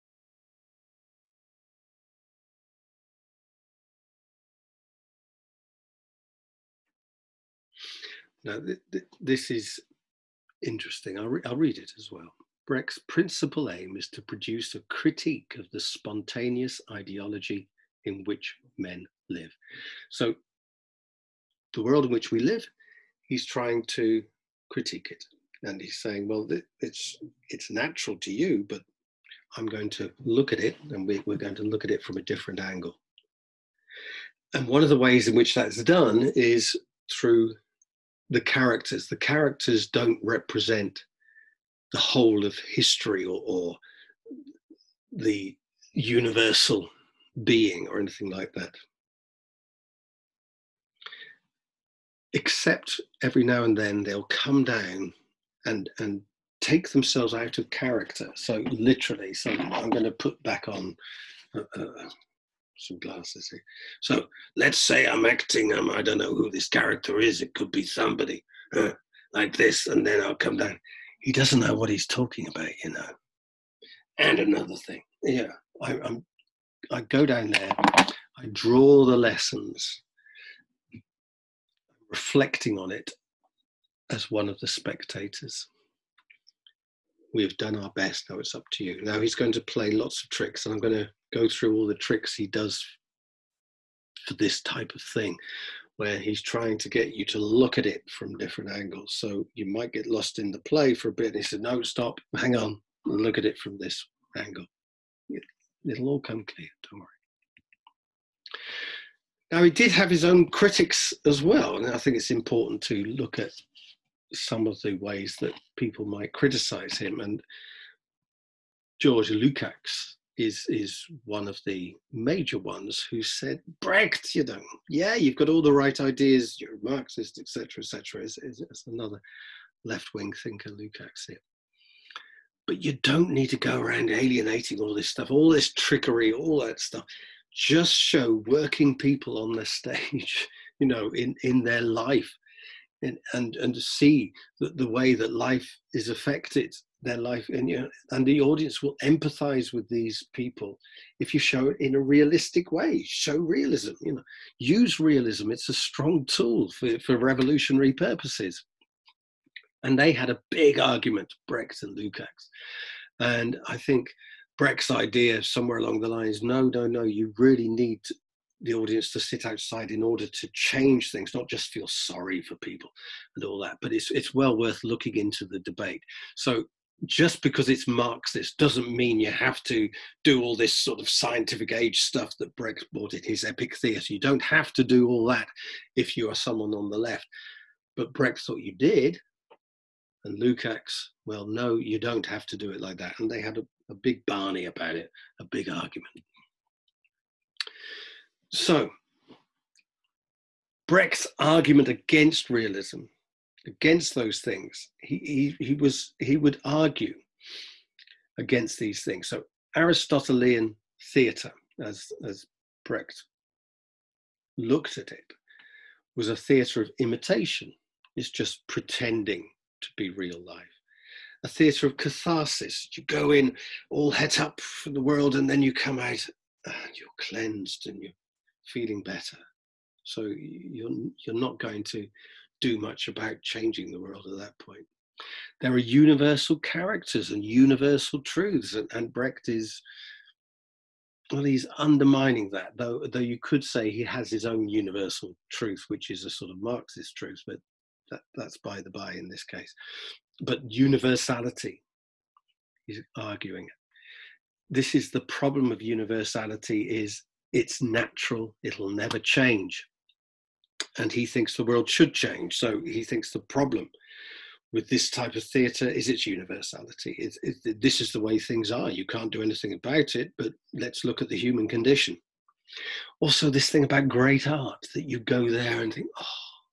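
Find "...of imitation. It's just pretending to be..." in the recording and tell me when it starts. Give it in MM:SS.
03:36.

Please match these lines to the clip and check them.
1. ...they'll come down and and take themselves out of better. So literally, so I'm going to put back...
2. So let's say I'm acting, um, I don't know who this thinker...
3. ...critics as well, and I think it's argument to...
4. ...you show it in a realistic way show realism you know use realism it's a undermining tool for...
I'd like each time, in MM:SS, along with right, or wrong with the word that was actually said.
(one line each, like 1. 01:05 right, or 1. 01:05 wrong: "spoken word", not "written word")
1. 00:54 wrong: "character", not "better"
2. 01:04 wrong: "character", not "thinker"
3. 01:50 wrong: "important", not "argument"
4. 02:31 wrong: "strong", not "undermining".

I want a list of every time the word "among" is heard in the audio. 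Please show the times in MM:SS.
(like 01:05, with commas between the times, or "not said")
not said.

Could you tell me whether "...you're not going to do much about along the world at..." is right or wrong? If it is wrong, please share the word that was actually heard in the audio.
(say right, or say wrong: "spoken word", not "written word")
wrong: "changing", not "along".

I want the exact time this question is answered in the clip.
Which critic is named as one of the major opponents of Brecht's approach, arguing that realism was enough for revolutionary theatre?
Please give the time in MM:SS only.
01:58.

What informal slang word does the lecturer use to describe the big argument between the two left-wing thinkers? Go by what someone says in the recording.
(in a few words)
Barney.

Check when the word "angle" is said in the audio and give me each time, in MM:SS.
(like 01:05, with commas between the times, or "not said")
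00:32, 01:38, 01:44.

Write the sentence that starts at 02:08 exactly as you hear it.
Is, is, is another left wing thinker, Lukács here.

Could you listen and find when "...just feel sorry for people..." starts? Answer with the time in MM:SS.
02:51.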